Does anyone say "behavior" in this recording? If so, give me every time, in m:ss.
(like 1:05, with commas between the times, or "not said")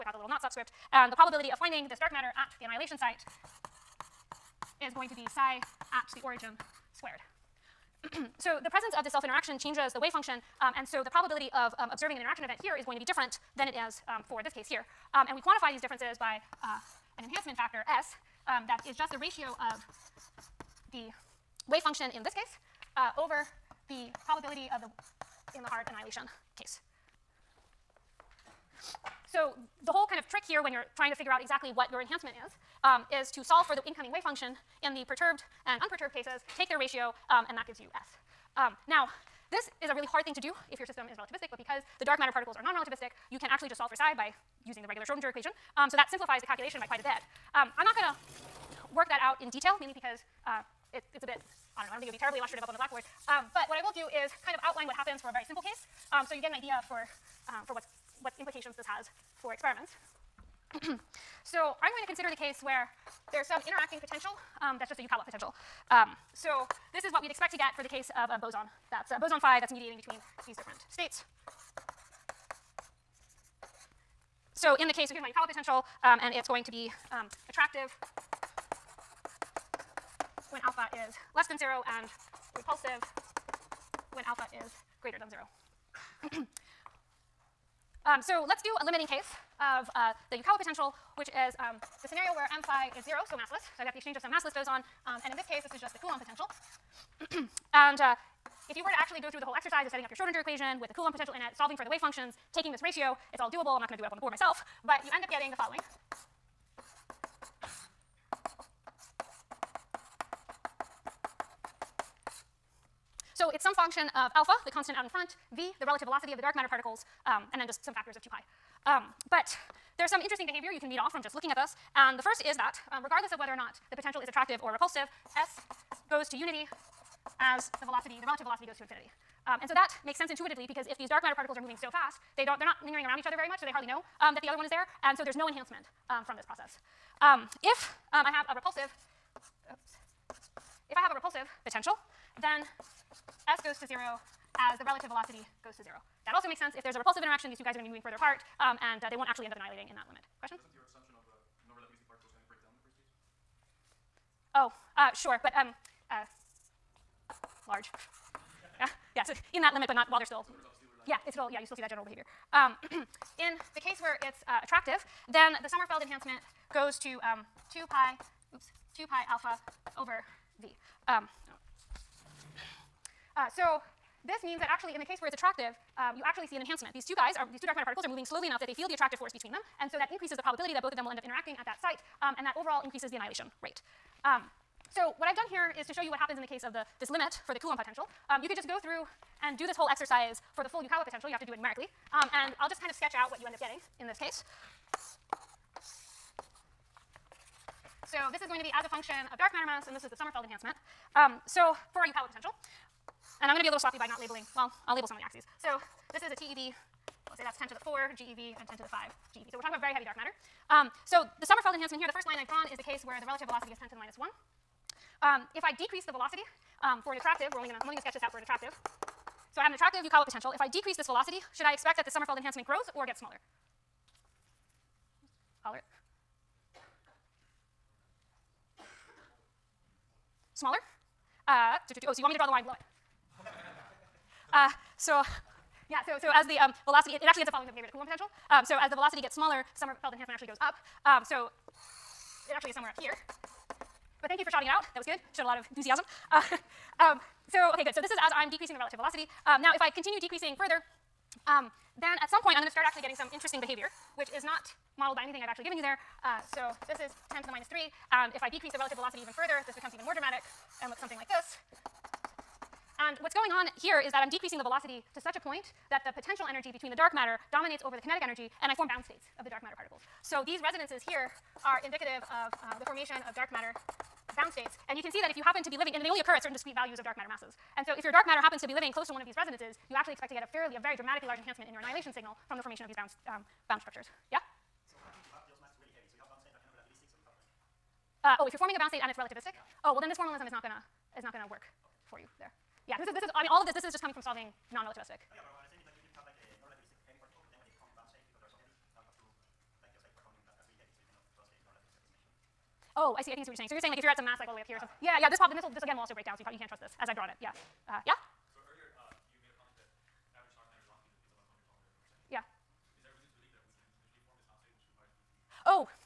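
2:00, 2:42, 3:57, 4:13.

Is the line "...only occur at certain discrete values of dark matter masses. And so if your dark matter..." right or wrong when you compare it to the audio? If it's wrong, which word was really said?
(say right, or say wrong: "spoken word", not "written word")
right.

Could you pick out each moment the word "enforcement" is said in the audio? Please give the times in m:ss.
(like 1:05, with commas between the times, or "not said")
not said.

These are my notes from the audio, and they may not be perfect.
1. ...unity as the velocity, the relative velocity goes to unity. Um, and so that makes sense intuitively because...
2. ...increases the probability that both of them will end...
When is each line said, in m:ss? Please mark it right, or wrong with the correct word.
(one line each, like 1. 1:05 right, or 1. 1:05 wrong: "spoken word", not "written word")
1. 2:06 wrong: "infinity", not "unity"
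2. 3:00 right.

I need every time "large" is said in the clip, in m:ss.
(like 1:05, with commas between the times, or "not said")
2:37, 4:41.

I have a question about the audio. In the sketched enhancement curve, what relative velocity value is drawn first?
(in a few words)
10^-1.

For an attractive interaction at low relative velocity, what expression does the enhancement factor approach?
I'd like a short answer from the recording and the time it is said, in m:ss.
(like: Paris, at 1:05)
2 pi alpha over v, at 2:48.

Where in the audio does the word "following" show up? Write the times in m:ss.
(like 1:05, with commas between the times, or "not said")
1:45, 3:57.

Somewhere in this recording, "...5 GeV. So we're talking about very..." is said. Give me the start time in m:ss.
3:28.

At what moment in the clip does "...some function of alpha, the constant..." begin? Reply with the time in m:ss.
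1:53.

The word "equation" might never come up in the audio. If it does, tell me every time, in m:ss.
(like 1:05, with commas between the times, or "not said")
0:45, 1:40.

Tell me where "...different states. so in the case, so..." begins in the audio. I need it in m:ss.
1:10.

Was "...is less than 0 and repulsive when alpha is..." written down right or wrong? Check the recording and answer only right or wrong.
right.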